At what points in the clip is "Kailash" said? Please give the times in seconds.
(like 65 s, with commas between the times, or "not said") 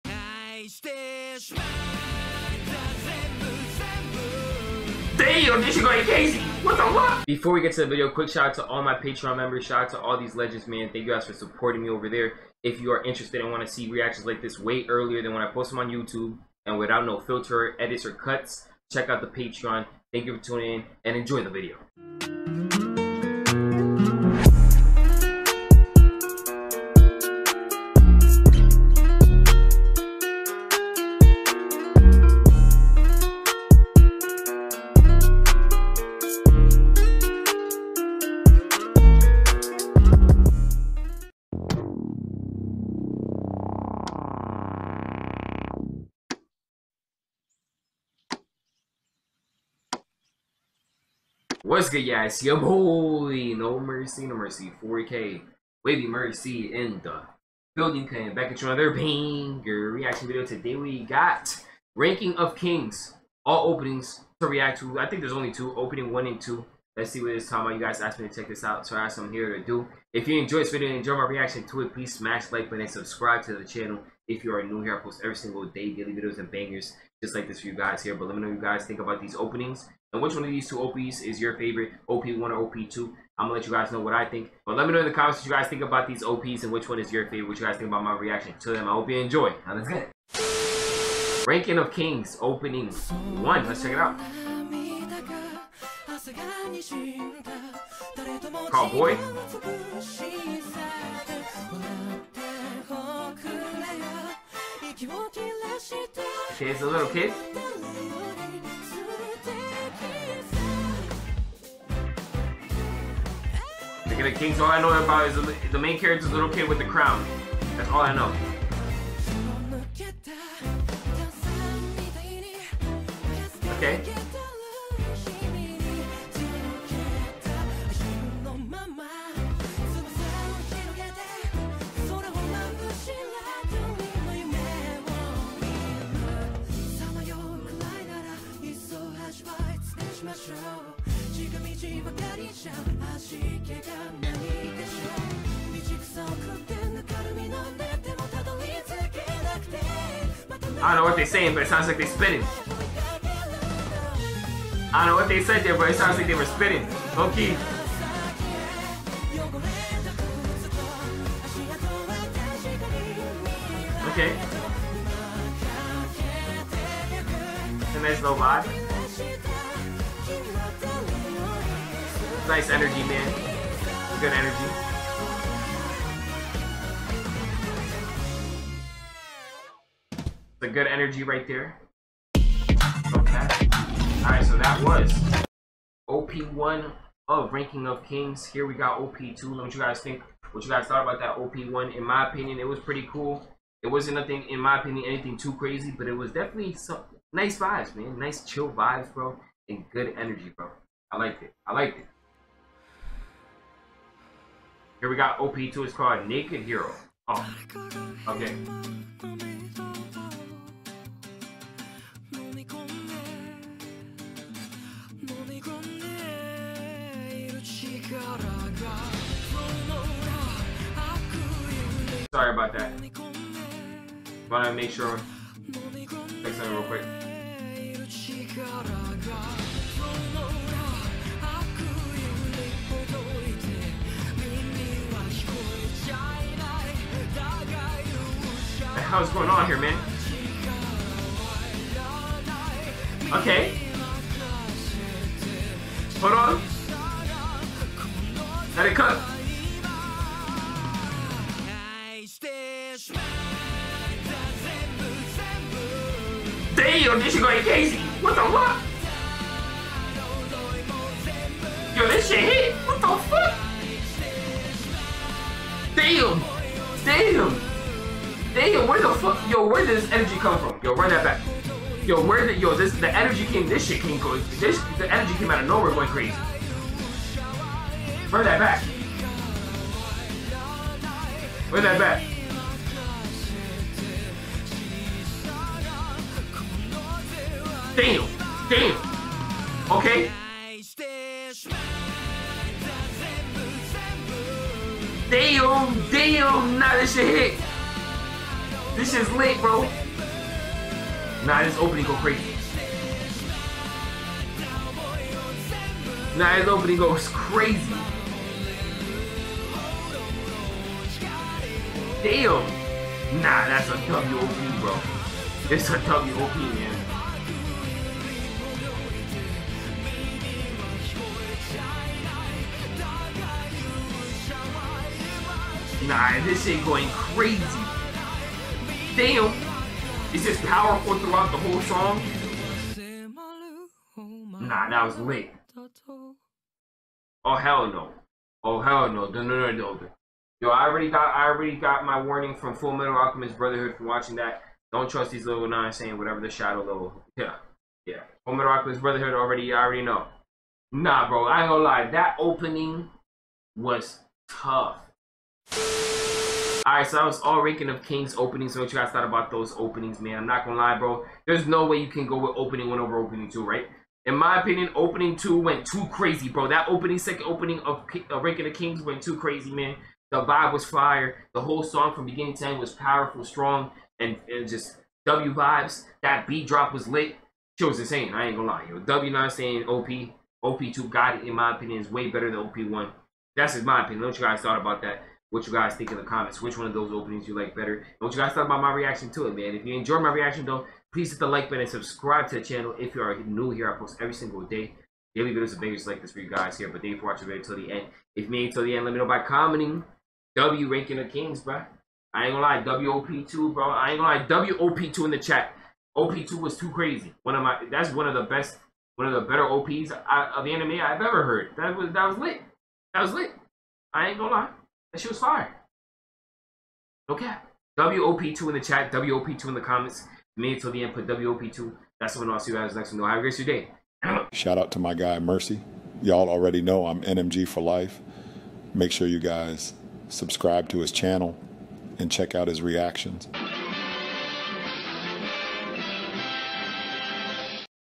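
not said.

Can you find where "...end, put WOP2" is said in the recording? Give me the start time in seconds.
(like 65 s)
421 s.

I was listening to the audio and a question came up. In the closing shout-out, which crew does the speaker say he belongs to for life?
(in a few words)
NMG.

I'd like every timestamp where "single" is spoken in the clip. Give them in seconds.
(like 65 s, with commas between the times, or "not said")
75 s, 394 s.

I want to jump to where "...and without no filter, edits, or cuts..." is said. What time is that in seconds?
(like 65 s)
16 s.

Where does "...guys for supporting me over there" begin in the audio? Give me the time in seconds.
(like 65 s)
11 s.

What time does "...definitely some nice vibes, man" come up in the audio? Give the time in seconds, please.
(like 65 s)
196 s.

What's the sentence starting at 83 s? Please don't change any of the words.
I'm gonna let you guys know what I think.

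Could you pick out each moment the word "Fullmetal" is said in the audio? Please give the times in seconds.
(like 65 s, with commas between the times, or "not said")
342 s, 348 s.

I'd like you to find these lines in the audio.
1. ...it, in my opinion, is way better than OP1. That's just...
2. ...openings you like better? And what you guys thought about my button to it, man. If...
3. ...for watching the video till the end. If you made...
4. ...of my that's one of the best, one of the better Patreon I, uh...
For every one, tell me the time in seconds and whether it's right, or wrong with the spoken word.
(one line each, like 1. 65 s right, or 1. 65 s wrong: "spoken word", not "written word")
1. 381 s right
2. 387 s wrong: "reaction", not "button"
3. 397 s right
4. 407 s wrong: "OPs", not "Patreon".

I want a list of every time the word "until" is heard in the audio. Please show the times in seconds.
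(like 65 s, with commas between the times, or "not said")
420 s.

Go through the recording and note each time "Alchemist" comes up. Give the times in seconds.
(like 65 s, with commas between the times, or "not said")
343 s, 348 s.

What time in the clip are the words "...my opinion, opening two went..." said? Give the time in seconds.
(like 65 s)
364 s.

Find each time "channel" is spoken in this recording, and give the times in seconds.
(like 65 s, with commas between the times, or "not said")
73 s, 392 s, 431 s.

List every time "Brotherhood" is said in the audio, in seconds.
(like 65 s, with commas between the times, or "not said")
343 s, 349 s.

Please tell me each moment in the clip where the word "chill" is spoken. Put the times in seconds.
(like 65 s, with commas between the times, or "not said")
198 s.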